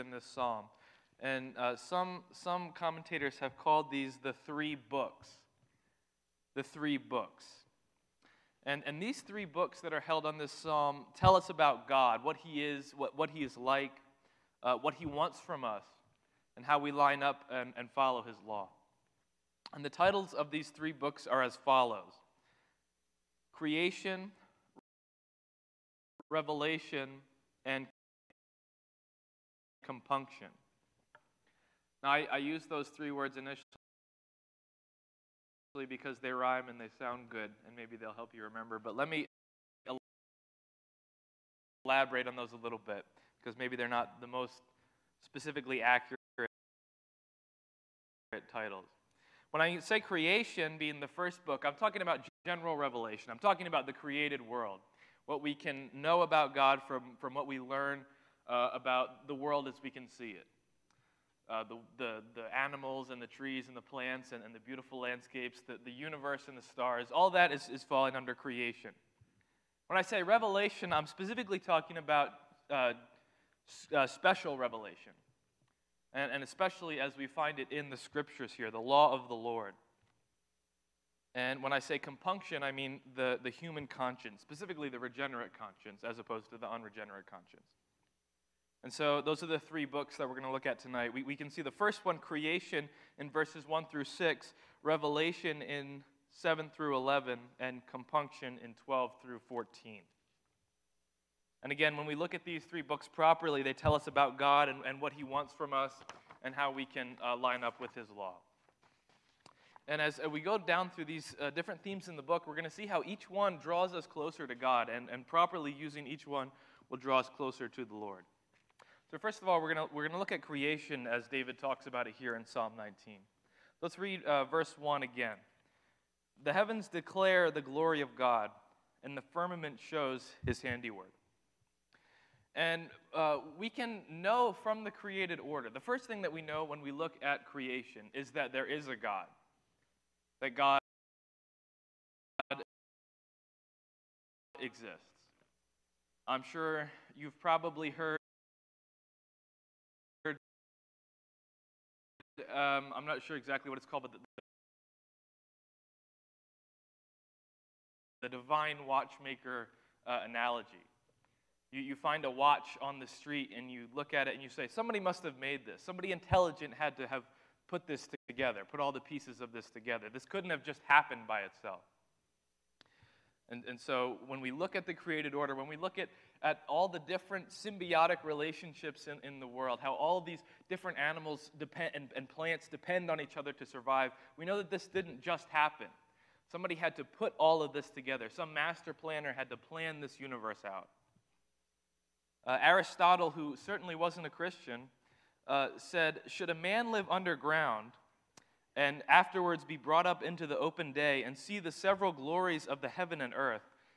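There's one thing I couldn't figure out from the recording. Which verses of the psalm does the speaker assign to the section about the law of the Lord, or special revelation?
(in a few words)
7 through 11.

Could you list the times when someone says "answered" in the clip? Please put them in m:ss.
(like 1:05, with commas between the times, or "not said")
not said.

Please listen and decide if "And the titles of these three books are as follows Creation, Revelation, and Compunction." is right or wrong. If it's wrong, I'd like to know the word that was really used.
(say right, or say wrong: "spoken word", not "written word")
right.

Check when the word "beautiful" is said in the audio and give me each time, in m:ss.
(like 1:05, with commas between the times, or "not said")
1:04.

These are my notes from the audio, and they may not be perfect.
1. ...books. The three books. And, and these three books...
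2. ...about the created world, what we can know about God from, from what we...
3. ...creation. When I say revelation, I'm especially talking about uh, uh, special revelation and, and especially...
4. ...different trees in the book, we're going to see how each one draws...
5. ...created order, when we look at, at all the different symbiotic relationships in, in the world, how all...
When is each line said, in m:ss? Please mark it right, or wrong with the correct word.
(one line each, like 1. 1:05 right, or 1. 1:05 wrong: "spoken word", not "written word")
1. 0:04 right
2. 0:53 right
3. 1:08 wrong: "specifically", not "especially"
4. 1:51 wrong: "themes", not "trees"
5. 2:54 right.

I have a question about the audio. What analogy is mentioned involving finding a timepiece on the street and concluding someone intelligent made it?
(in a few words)
Divine watchmaker.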